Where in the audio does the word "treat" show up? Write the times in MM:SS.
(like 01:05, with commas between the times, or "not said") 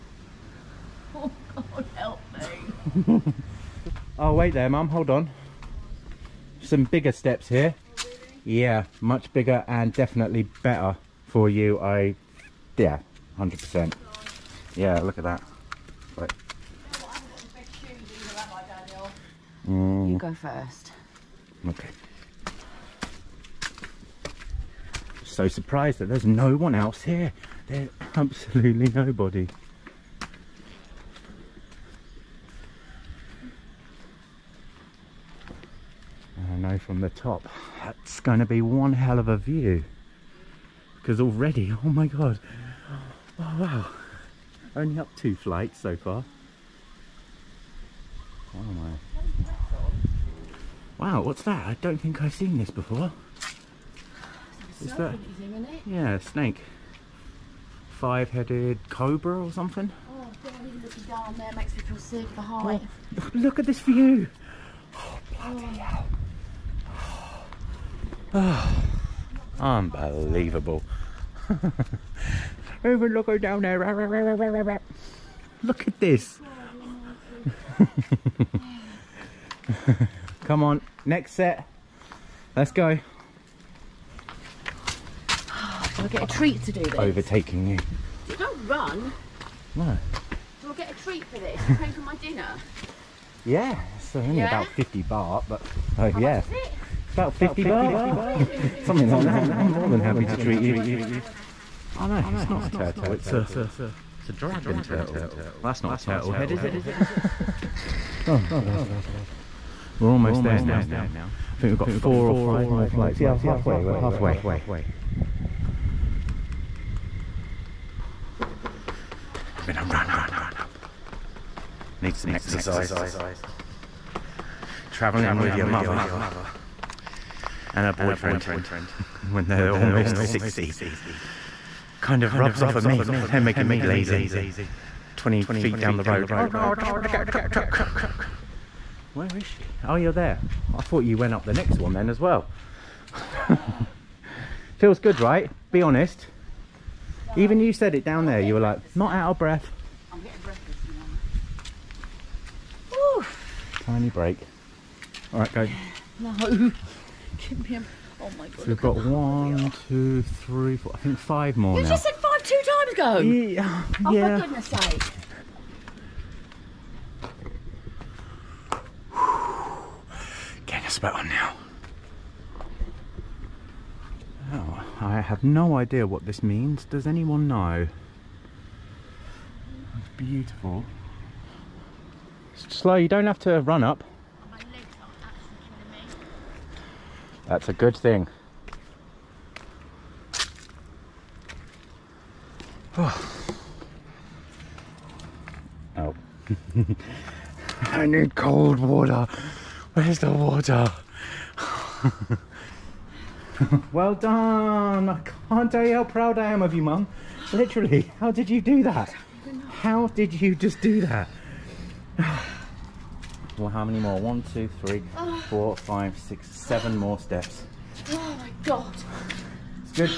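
01:26, 01:31, 01:40.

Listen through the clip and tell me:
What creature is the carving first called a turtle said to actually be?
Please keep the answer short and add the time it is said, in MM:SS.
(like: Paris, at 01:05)
dragon turtle, at 01:44.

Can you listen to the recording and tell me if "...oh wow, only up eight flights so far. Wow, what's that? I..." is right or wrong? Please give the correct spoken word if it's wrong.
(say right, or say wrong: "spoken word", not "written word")
wrong: "two", not "eight".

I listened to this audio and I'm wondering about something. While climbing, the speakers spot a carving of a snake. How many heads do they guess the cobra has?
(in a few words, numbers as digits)
5.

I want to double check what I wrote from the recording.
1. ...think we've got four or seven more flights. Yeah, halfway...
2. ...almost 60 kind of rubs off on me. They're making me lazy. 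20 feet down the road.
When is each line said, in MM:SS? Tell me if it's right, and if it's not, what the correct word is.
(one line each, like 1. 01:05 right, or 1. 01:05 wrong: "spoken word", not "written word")
1. 01:51 wrong: "five", not "seven"
2. 02:09 right.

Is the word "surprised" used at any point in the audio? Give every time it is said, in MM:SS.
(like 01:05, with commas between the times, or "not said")
00:25.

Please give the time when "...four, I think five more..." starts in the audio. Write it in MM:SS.
02:40.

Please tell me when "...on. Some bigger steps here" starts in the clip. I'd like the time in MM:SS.
00:05.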